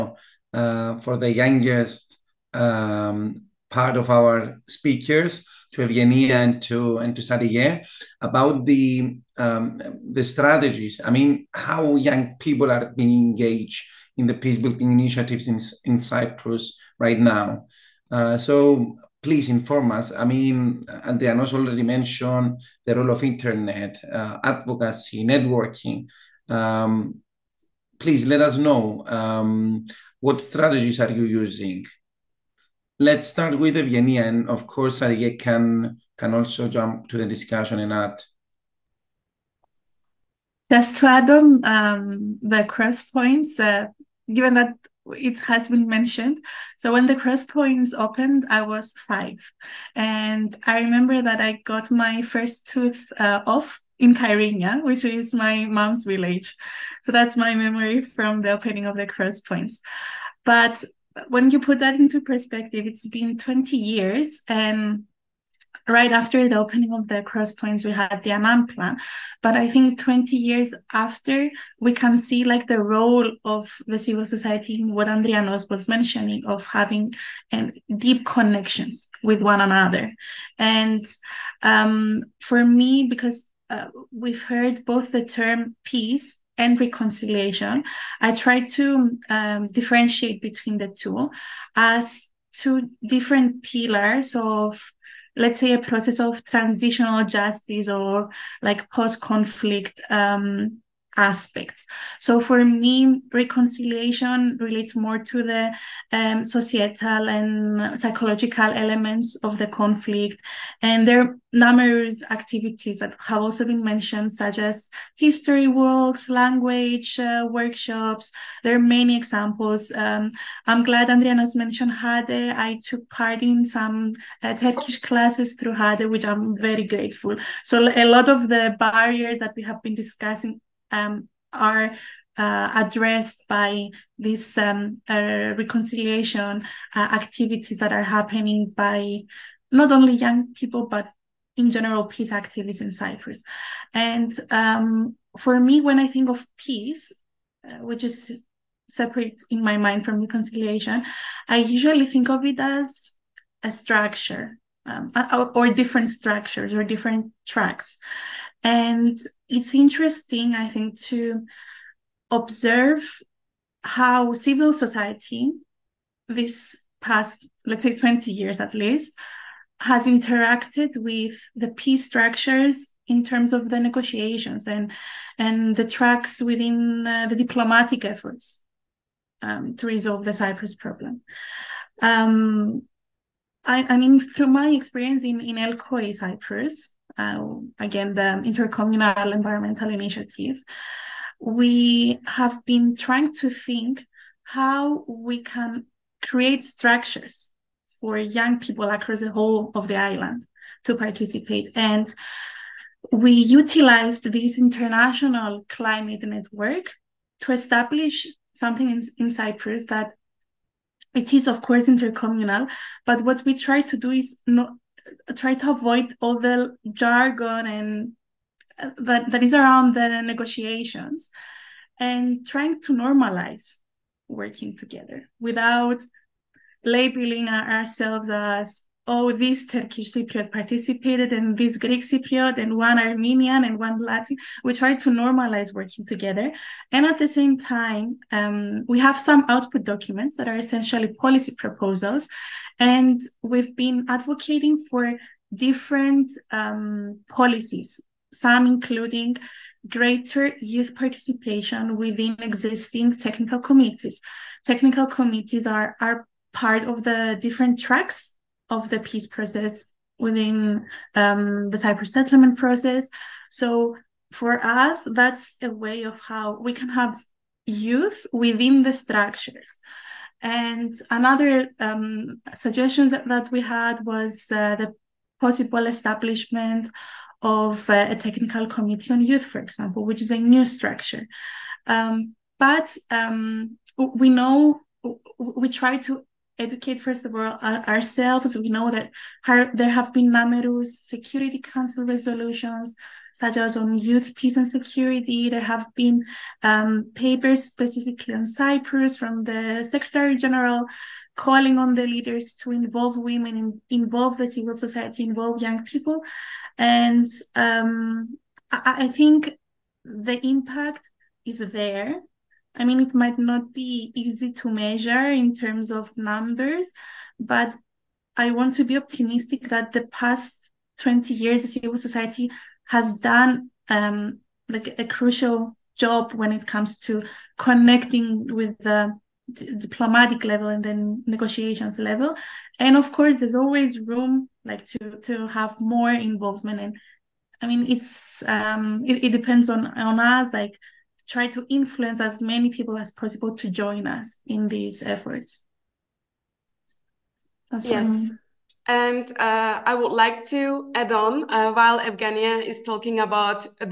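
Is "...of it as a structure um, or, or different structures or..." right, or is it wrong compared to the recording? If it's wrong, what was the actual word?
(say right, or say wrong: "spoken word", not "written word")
right.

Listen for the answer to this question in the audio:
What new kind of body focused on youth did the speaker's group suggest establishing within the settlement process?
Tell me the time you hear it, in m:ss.
4:38.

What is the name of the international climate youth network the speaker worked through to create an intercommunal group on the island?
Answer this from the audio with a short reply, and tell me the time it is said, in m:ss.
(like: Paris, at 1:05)
LCOY, at 3:05.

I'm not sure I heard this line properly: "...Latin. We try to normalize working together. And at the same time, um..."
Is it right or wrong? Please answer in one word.
right.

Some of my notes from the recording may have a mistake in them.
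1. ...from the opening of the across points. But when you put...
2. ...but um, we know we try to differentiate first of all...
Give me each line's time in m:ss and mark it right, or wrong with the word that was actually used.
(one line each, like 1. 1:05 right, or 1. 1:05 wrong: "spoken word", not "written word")
1. 0:57 wrong: "cross", not "across"
2. 4:42 wrong: "educate", not "differentiate".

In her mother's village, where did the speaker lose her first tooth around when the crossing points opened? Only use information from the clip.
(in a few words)
Kyrenia.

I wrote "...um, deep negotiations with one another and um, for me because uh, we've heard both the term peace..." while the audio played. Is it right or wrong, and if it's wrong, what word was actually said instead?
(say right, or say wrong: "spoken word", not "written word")
wrong: "connections", not "negotiations".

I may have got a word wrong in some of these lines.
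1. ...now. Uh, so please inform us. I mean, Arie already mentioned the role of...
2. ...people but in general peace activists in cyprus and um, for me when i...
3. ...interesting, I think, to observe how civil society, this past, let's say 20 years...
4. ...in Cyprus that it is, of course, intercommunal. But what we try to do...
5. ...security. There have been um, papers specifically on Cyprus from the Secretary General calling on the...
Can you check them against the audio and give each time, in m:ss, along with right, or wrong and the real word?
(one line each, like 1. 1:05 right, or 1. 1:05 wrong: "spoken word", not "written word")
1. 0:17 wrong: "Andrianos", not "Arie"
2. 2:20 right
3. 2:39 right
4. 3:29 right
5. 4:54 right.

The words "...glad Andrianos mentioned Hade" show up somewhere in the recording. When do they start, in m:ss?
2:00.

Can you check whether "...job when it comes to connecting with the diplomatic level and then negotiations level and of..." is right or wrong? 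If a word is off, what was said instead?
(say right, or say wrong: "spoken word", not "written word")
right.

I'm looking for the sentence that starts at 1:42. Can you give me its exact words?
So for me, reconciliation relates more to the um, societal and psychological elements of the conflict.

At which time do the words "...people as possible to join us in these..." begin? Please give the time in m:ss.
5:42.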